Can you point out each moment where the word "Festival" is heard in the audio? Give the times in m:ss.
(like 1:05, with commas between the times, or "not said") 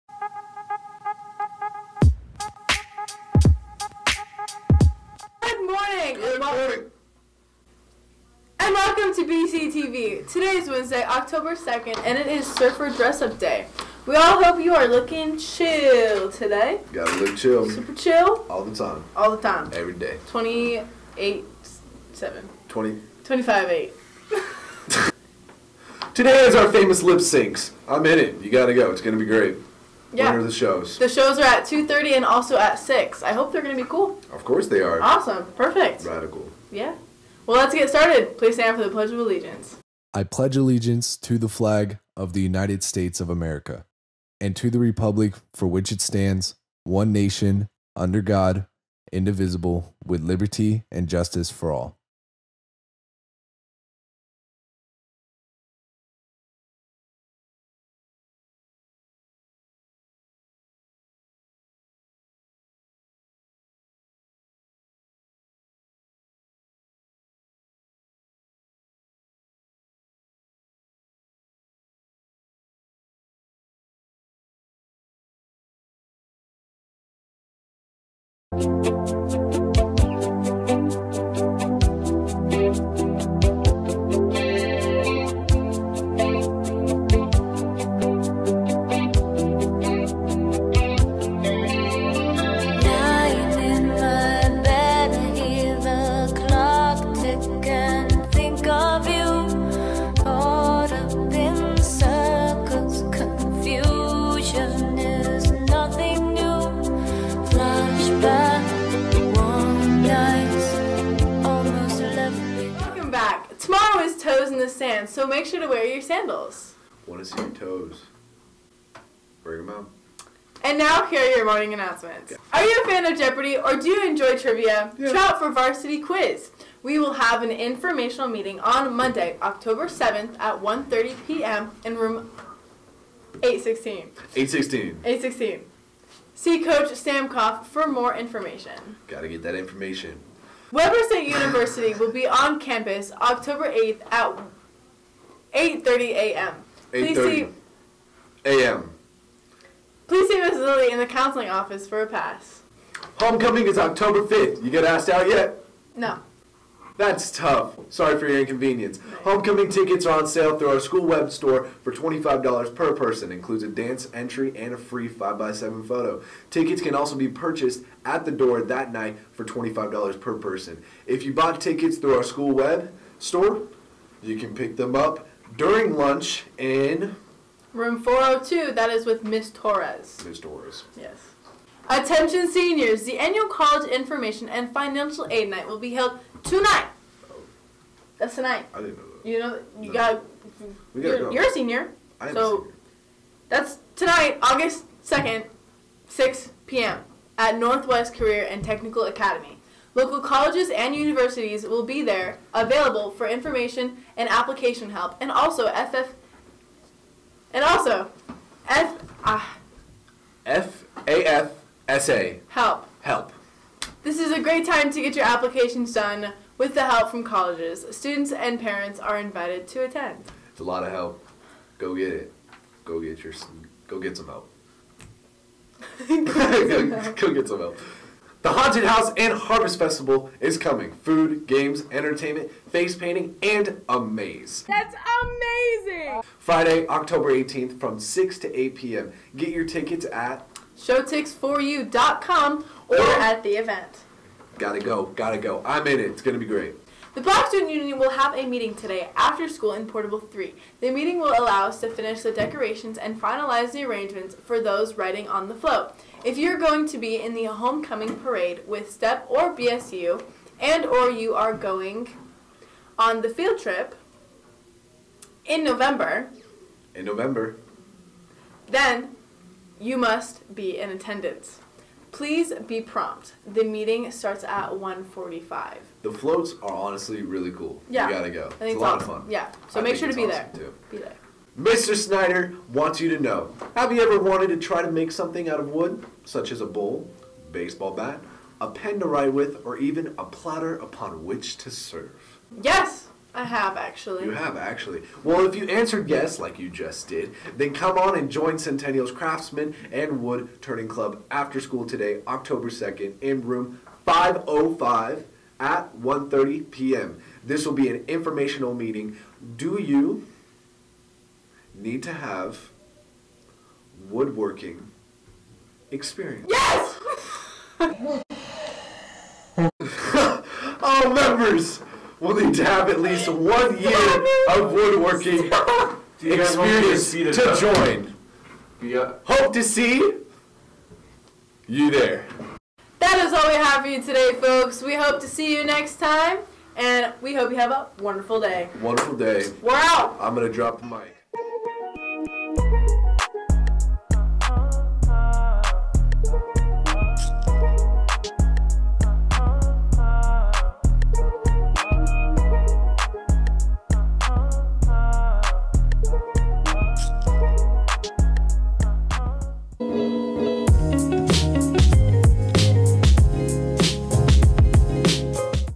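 3:49.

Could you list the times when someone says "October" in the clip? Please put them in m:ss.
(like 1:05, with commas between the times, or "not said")
0:11, 2:09, 2:23, 2:33, 3:56, 5:02.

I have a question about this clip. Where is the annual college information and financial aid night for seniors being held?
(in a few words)
Northwest Career and Technical Academy.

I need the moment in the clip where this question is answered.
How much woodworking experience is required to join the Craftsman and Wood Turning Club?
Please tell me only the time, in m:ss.
5:23.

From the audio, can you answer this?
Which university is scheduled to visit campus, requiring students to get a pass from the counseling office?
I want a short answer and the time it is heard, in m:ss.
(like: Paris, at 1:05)
Weber State University, at 2:20.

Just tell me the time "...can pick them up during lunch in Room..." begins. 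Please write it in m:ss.
2:54.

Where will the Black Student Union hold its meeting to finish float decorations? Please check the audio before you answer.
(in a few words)
Portable 3.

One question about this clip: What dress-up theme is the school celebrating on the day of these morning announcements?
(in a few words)
Surfer Dress Up Day.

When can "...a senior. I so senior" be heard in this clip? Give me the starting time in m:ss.
3:11.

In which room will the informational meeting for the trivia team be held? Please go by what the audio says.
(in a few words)
816.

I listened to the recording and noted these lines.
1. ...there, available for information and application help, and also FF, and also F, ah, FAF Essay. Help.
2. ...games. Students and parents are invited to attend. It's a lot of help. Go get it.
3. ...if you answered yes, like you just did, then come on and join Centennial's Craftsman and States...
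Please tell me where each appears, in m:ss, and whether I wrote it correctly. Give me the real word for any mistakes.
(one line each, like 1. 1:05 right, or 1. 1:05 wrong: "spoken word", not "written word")
1. 3:22 right
2. 3:37 wrong: "colleges", not "games"
3. 4:55 wrong: "Wood", not "States".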